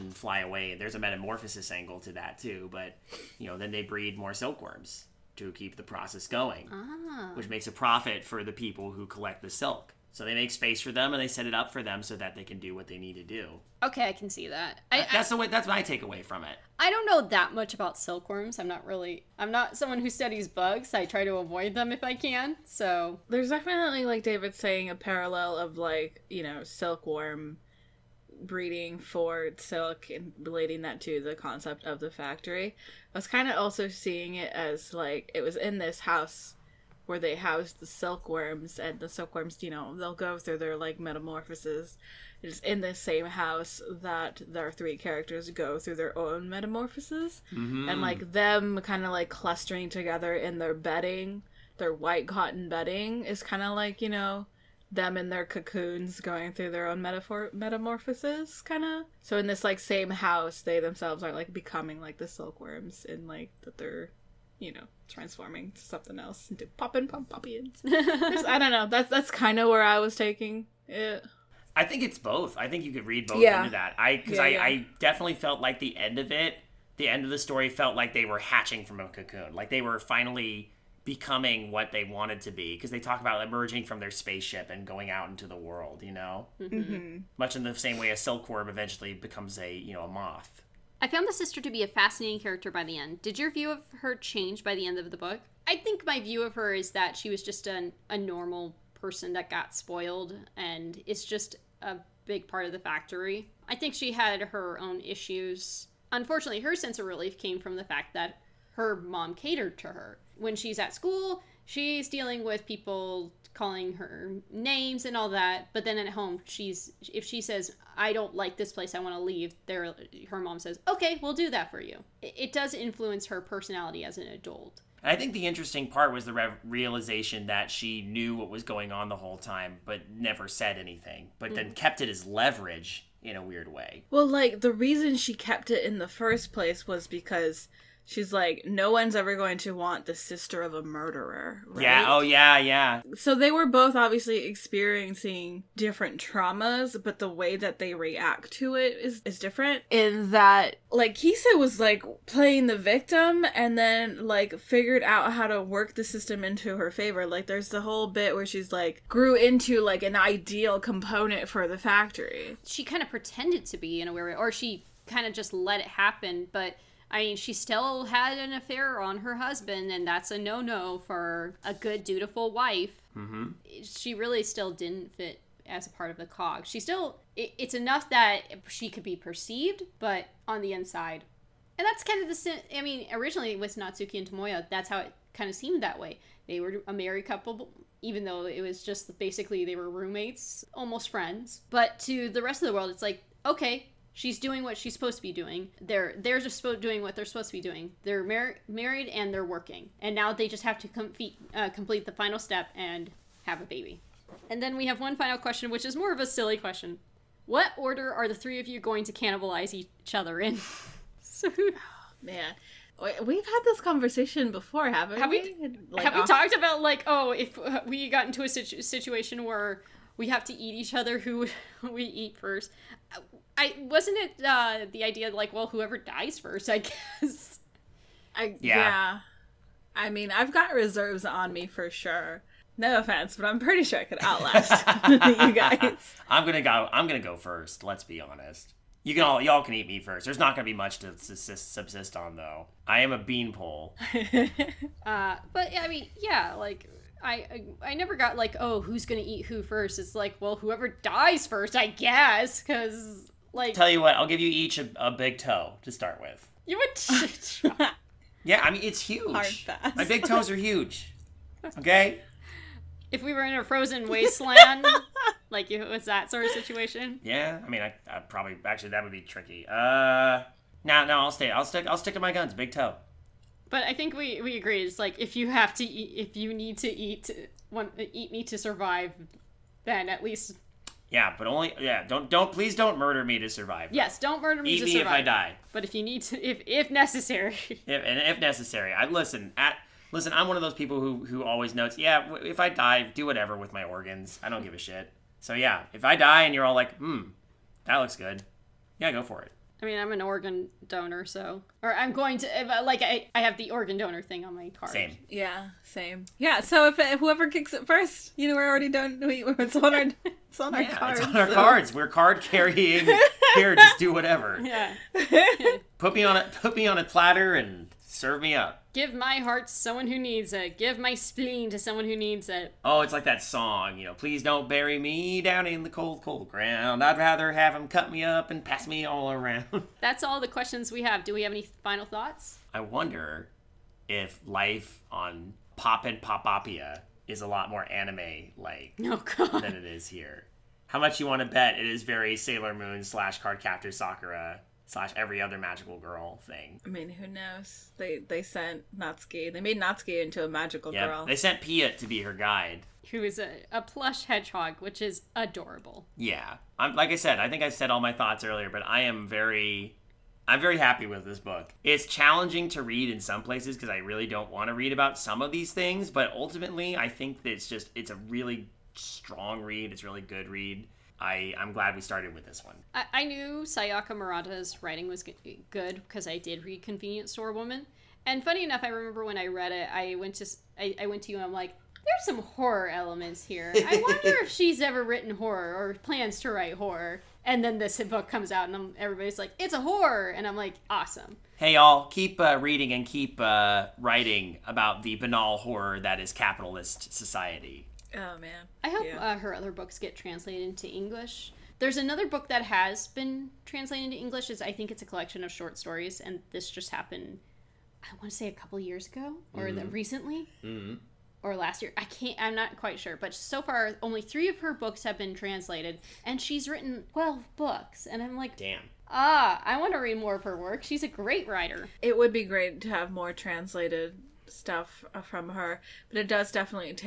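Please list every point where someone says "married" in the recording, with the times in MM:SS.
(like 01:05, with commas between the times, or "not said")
03:06, 03:18.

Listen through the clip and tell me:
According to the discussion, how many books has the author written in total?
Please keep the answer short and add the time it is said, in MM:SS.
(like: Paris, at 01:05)
12, at 06:57.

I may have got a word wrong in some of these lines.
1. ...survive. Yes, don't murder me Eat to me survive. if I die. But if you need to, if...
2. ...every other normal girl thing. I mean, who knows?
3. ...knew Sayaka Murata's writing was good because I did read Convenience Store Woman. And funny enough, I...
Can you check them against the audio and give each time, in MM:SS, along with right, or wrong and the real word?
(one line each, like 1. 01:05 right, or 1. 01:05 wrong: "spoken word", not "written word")
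1. 04:43 right
2. 05:45 wrong: "magical", not "normal"
3. 06:13 right.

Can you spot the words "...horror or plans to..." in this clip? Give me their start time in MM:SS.
06:25.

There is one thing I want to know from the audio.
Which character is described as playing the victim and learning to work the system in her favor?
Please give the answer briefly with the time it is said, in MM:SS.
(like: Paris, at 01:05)
Kisa, at 02:31.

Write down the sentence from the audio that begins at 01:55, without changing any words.
But then at home, she's if she says I don't like this place, I want to leave.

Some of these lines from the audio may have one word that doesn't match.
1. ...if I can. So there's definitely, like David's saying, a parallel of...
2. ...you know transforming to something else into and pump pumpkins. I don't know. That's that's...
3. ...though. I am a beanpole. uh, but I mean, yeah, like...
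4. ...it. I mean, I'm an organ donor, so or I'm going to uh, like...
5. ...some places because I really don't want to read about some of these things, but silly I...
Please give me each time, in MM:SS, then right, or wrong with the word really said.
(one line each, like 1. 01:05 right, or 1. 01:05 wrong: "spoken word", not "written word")
1. 00:21 right
2. 01:04 right
3. 04:02 right
4. 04:59 right
5. 06:03 wrong: "ultimately", not "silly".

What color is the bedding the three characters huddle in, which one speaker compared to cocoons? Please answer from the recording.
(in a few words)
White.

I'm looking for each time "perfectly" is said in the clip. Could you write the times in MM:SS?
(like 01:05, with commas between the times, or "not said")
not said.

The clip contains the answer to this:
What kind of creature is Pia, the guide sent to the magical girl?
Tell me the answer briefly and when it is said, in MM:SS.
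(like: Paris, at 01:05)
A plush hedgehog, at 05:53.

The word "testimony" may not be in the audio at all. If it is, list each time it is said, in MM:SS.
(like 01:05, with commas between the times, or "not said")
not said.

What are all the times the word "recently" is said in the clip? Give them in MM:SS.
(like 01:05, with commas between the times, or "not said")
06:49.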